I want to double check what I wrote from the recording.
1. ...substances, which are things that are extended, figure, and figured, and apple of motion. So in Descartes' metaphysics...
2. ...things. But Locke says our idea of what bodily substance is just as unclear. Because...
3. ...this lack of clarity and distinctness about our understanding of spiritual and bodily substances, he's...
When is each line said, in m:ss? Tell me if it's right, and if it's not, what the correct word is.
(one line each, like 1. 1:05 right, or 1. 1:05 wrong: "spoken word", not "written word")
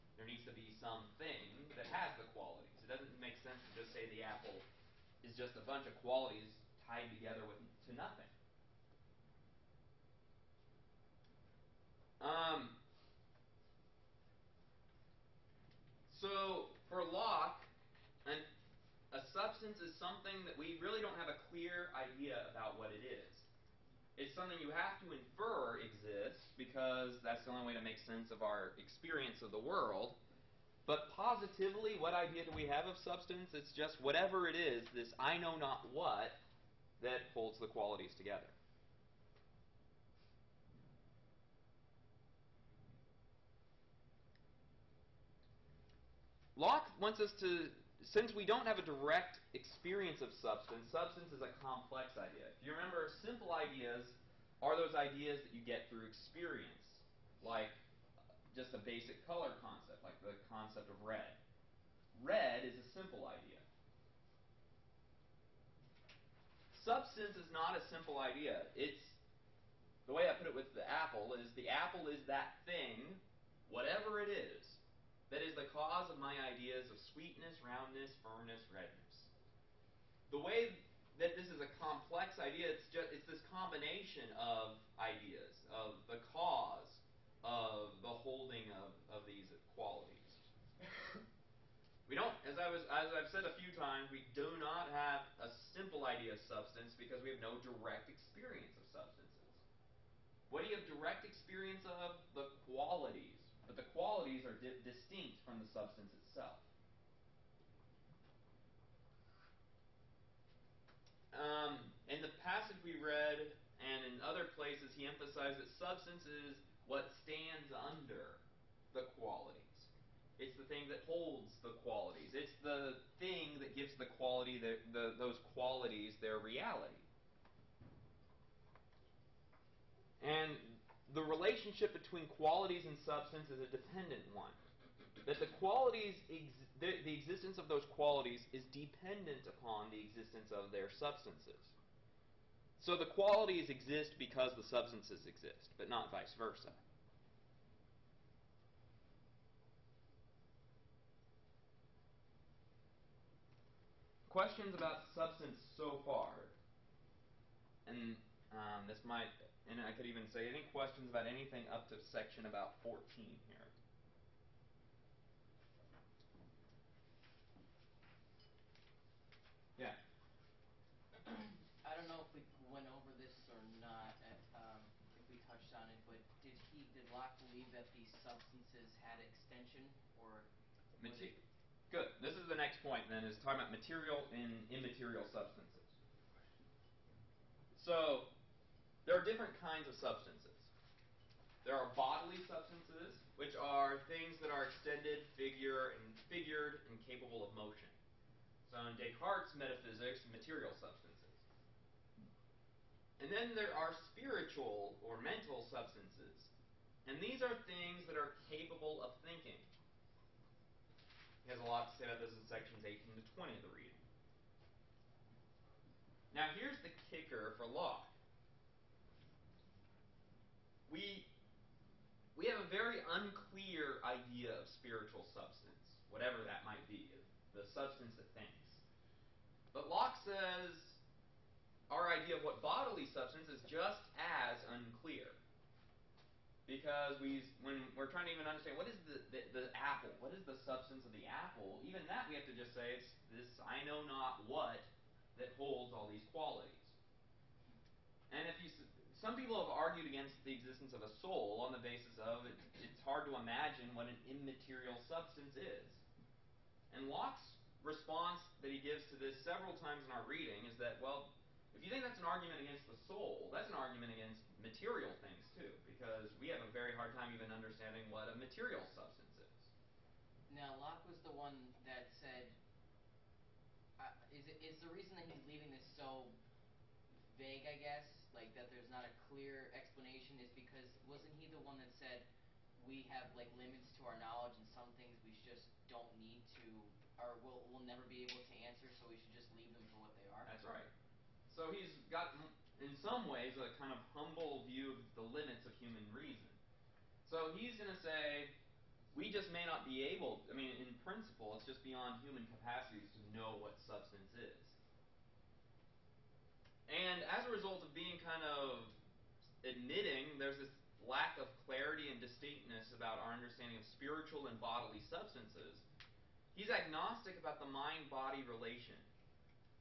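1. 3:12 wrong: "capable", not "apple"
2. 3:48 right
3. 5:10 right.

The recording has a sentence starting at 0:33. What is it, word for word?
It's just whatever it is, this I know not what, that holds the qualities together.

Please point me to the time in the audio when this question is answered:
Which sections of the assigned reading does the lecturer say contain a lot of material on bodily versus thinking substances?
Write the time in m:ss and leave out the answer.
3:32.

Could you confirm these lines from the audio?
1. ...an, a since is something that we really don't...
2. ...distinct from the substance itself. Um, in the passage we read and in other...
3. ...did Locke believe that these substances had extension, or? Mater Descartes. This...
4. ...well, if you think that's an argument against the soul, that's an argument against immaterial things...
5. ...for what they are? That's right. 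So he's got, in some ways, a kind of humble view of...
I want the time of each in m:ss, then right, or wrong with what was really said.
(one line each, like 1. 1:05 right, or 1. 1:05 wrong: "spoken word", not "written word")
1. 0:18 wrong: "substance", not "since"
2. 1:44 right
3. 2:56 wrong: "Good", not "Descartes"
4. 4:20 wrong: "material", not "immaterial"
5. 4:49 right.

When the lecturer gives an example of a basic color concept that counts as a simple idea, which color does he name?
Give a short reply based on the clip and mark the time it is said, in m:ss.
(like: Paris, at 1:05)
red, at 1:00.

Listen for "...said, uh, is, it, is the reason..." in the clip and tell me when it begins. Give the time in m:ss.
4:32.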